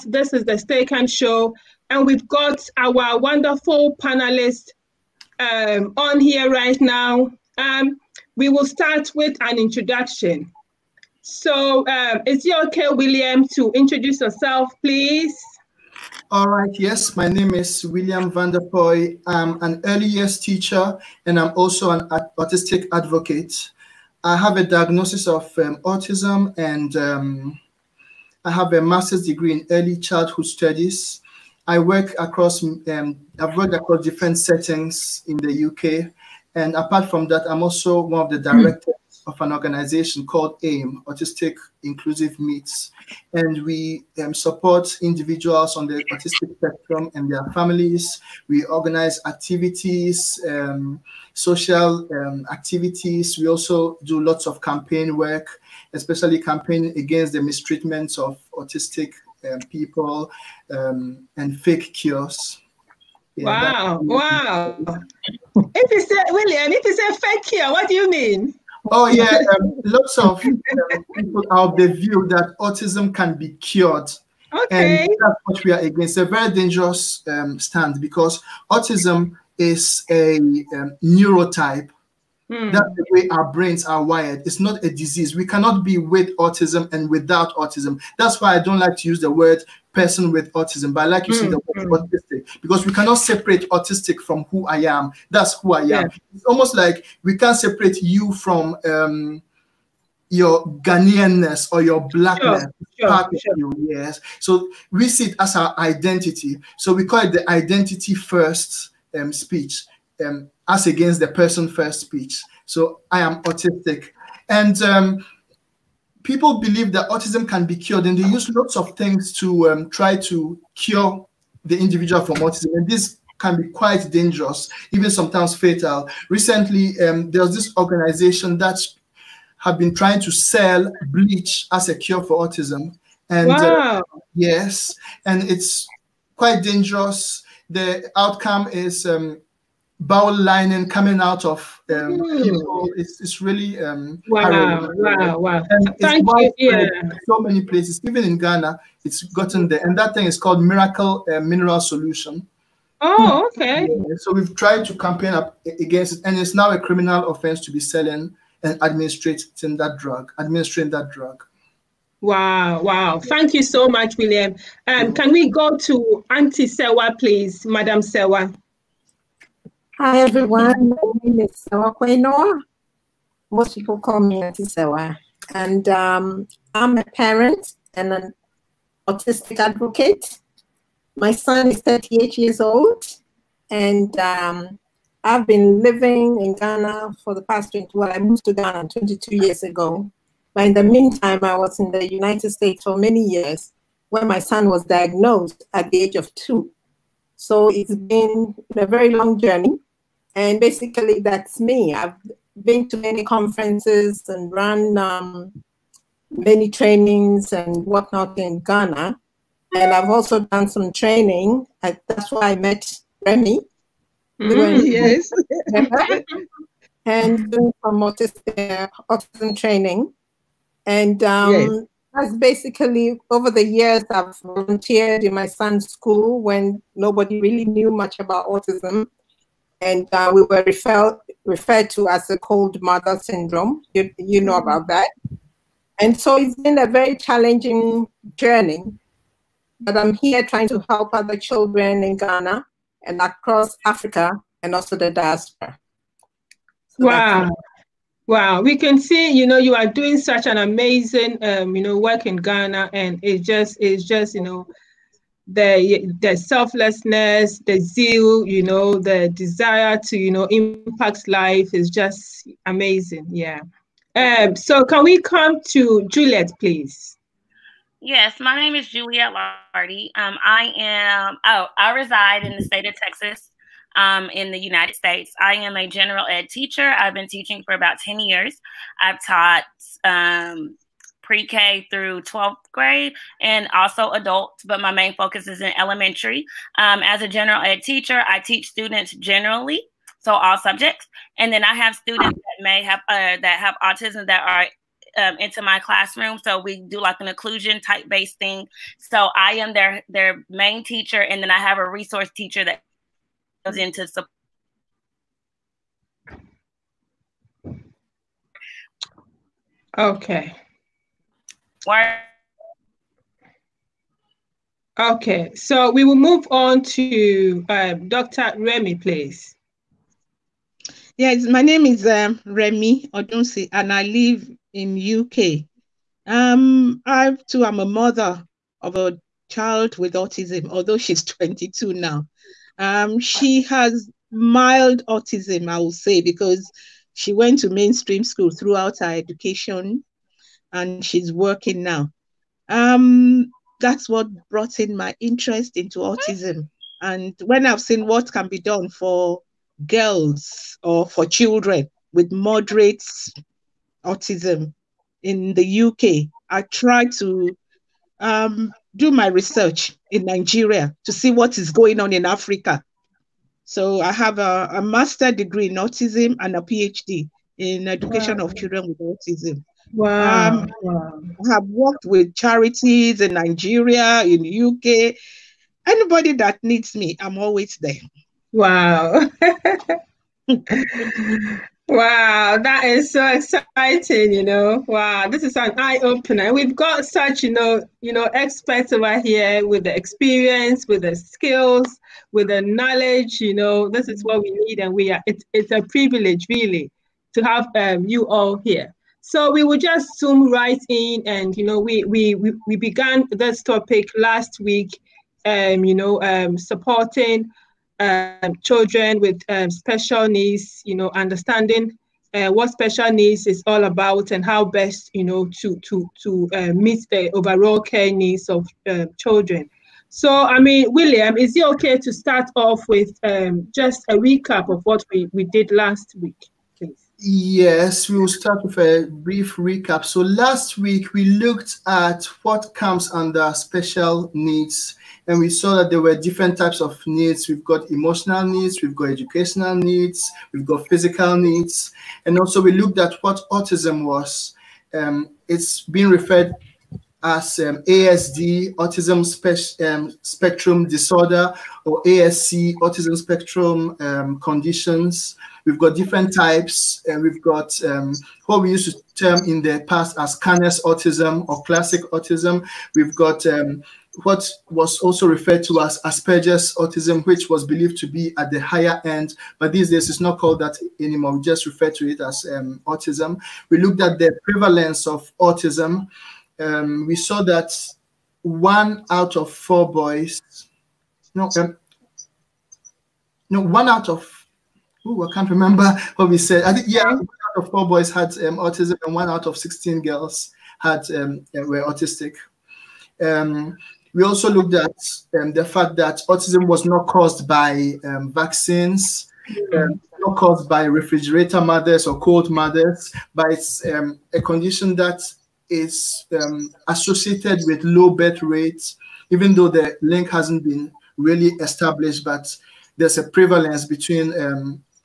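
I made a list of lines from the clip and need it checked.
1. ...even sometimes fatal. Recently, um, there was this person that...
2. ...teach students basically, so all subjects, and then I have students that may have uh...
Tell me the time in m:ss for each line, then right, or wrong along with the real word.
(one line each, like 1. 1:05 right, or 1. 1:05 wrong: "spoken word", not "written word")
1. 2:04 wrong: "organization", not "person"
2. 4:48 wrong: "generally", not "basically".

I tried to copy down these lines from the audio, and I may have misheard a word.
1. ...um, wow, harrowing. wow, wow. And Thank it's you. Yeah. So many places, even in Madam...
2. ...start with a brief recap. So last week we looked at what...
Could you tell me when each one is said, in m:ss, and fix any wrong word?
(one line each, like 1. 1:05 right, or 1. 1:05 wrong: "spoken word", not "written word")
1. 2:23 wrong: "Ghana", not "Madam"
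2. 7:08 right.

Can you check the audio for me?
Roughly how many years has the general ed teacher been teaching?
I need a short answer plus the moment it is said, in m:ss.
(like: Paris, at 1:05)
10, at 4:37.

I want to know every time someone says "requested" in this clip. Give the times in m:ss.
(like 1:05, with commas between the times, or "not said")
not said.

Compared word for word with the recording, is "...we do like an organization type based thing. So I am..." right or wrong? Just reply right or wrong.
wrong.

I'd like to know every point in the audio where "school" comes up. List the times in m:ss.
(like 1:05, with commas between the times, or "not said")
3:45, 5:38.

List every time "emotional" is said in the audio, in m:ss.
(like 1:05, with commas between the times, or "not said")
7:17.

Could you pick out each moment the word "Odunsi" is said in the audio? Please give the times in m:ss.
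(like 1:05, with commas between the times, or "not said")
5:23.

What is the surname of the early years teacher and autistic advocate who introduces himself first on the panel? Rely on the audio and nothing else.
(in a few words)
Vanderpoy.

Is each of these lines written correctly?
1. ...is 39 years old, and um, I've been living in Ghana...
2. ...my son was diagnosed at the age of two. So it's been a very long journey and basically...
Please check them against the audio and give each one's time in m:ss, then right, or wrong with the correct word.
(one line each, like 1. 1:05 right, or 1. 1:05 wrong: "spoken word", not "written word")
1. 3:01 wrong: "38", not "39"
2. 3:14 right.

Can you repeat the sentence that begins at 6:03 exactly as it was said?
So I have a, a master degree in autism and a PhD in education wow.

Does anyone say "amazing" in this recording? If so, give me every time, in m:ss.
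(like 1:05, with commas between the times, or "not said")
4:10, 4:22.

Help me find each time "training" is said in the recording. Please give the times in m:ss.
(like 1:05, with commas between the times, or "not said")
3:26, 3:30, 3:39.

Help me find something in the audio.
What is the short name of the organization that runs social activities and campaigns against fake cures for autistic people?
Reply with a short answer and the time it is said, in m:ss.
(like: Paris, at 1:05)
AIM, at 0:40.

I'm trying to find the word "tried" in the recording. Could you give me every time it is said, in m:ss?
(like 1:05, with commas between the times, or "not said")
2:34, 5:56.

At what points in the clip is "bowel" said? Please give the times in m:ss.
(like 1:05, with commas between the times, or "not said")
2:20.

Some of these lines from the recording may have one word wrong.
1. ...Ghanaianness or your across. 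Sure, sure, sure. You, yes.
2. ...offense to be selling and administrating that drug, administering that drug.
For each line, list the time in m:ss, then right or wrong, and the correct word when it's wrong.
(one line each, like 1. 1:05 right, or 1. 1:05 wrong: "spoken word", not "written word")
1. 1:40 wrong: "blackness", not "across"
2. 2:37 right.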